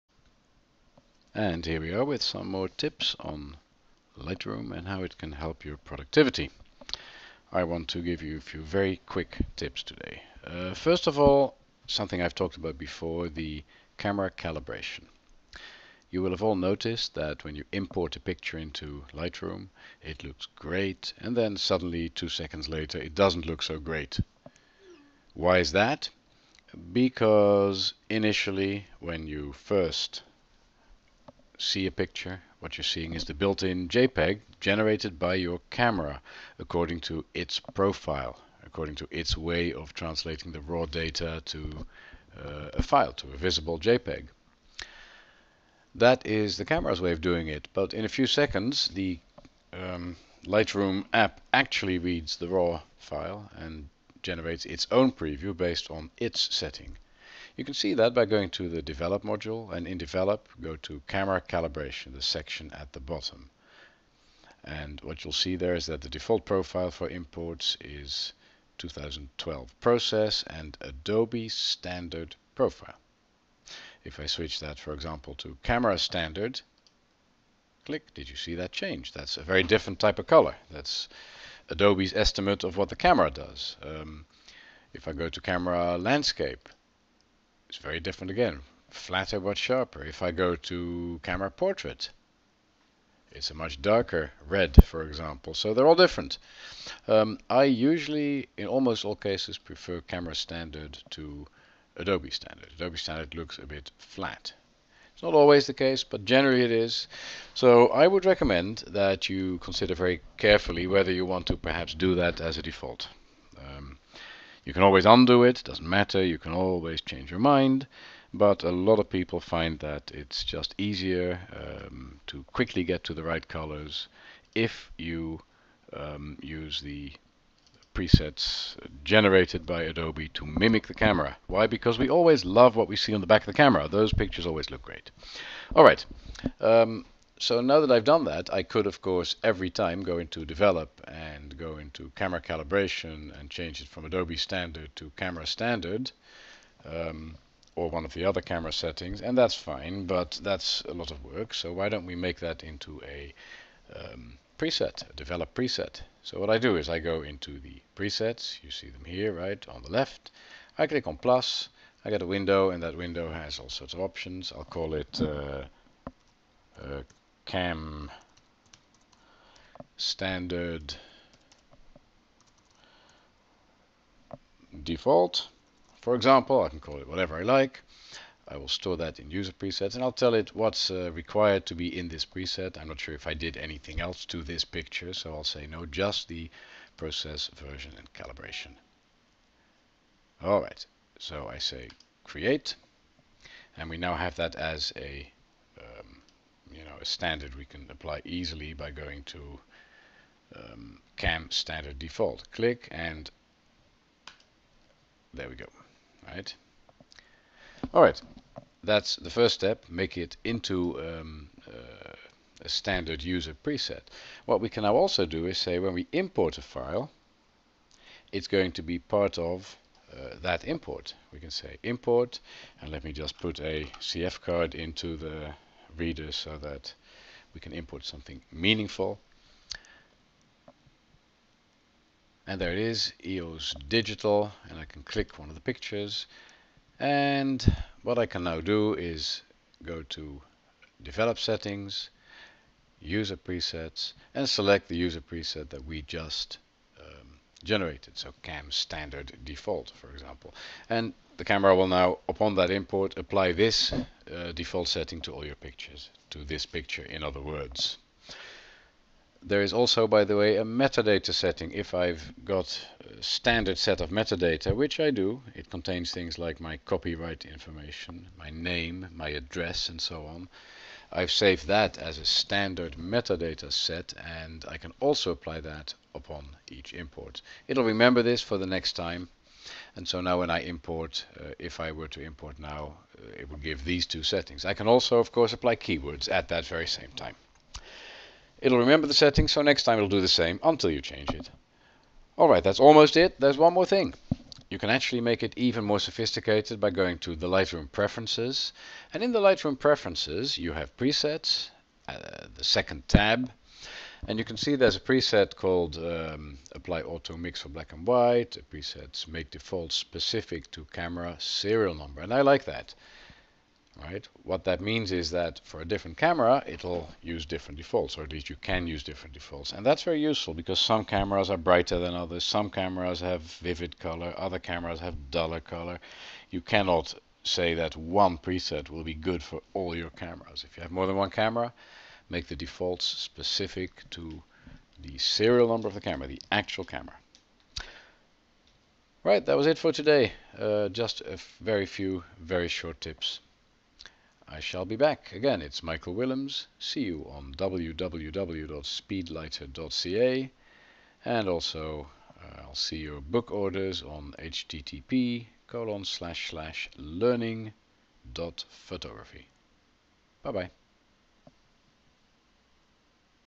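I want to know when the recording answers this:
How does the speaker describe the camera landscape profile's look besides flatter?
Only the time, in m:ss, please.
1:29.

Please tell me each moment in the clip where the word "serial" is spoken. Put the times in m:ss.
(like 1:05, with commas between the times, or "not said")
5:11, 5:35.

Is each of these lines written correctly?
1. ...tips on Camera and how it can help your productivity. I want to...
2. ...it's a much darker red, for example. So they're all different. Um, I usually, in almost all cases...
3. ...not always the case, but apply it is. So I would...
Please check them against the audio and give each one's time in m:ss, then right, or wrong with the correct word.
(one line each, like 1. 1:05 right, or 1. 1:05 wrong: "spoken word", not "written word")
1. 0:02 wrong: "Lightroom", not "Camera"
2. 1:33 right
3. 1:45 wrong: "generally", not "apply".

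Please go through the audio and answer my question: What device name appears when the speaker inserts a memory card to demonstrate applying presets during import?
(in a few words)
EOS Digital.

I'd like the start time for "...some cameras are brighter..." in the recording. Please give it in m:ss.
5:20.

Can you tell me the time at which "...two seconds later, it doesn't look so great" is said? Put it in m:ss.
0:22.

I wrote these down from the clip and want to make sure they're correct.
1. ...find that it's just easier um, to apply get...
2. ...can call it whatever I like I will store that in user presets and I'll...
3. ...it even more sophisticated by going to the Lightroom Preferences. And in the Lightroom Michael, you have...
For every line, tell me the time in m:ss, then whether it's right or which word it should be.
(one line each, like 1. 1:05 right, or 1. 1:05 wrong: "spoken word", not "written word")
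1. 1:59 wrong: "quickly", not "apply"
2. 2:56 right
3. 4:55 wrong: "Preferences", not "Michael".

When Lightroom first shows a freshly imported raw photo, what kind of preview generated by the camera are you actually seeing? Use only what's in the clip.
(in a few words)
built-in JPEG.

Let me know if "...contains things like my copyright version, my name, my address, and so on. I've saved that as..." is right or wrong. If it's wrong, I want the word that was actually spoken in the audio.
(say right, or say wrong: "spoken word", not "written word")
wrong: "information", not "version".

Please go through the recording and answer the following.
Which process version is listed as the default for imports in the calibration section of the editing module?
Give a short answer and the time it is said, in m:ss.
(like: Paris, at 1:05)
2012, at 1:08.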